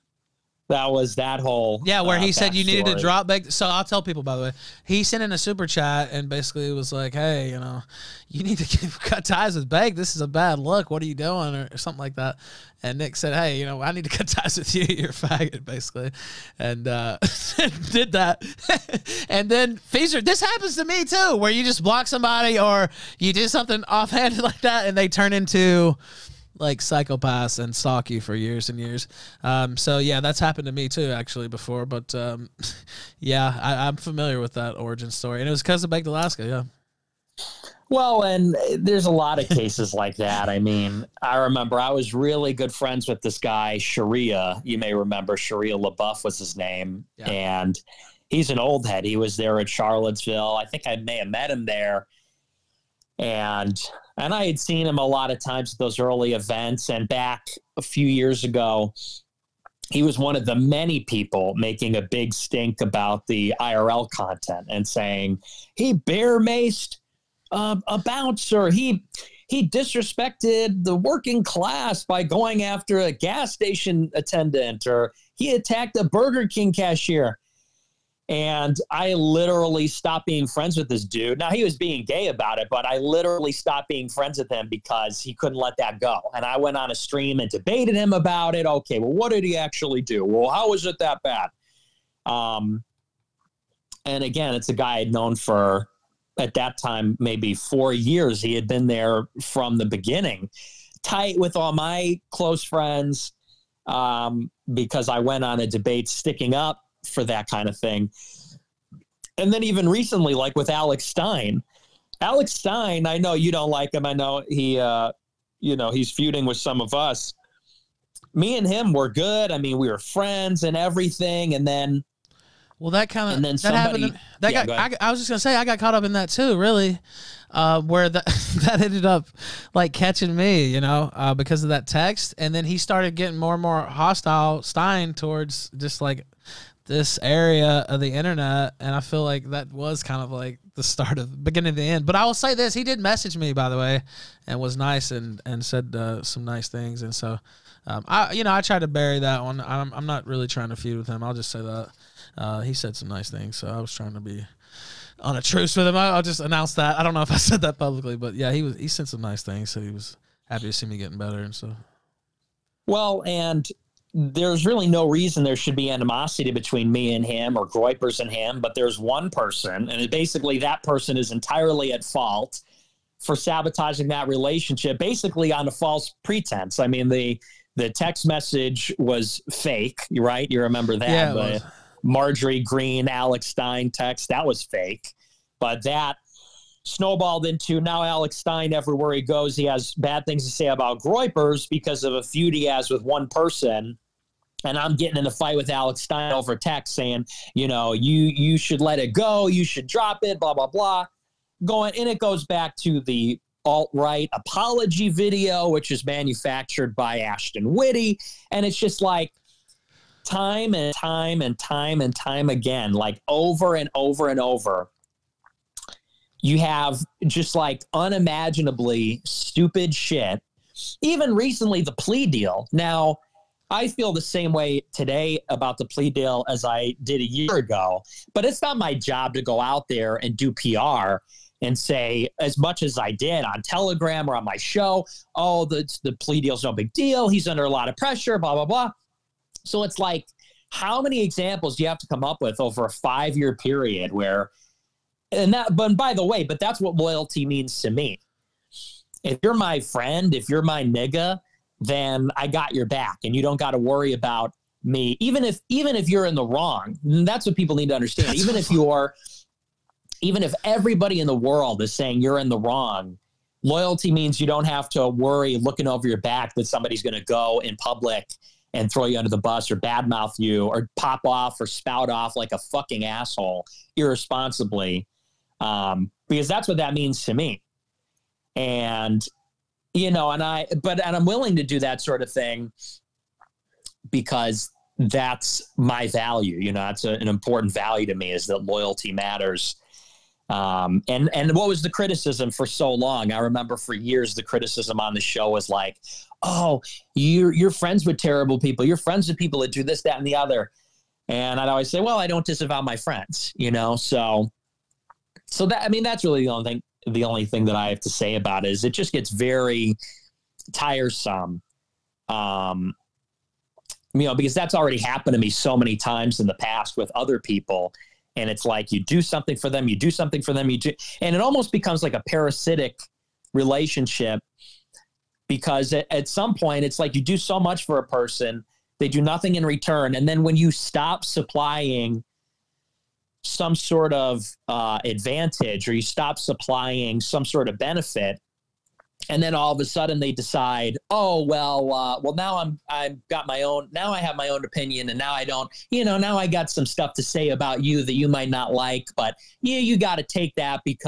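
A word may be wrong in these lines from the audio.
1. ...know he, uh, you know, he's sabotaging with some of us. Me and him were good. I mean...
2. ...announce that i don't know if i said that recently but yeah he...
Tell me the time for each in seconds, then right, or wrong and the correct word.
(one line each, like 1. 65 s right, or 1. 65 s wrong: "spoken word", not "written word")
1. 114 s wrong: "feuding", not "sabotaging"
2. 156 s wrong: "publicly", not "recently".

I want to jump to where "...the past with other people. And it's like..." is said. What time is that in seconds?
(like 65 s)
316 s.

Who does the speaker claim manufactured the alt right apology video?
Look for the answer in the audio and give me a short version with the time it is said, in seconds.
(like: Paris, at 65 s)
Ashton Whitney, at 207 s.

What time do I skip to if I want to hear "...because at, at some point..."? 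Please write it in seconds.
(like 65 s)
325 s.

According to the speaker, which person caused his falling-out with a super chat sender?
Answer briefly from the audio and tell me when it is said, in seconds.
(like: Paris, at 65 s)
Baked Alaska, at 35 s.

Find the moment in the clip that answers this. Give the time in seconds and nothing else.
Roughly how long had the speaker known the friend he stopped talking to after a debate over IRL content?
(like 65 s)
97 s.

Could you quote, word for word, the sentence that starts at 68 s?
He he disrespected the working class by going after a gas station attendant, or he attacked a Burger King cashier.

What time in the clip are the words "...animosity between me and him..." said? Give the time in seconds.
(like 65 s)
165 s.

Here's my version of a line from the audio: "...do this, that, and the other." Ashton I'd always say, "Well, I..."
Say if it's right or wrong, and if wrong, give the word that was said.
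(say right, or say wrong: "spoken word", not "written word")
wrong: "And", not "Ashton".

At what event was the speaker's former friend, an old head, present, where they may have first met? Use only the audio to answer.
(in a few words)
Charlottesville.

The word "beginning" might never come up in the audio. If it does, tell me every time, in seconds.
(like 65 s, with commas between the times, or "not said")
99 s, 141 s.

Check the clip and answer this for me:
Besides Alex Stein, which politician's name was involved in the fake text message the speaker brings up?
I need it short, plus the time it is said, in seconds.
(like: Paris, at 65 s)
Marjorie Greene, at 182 s.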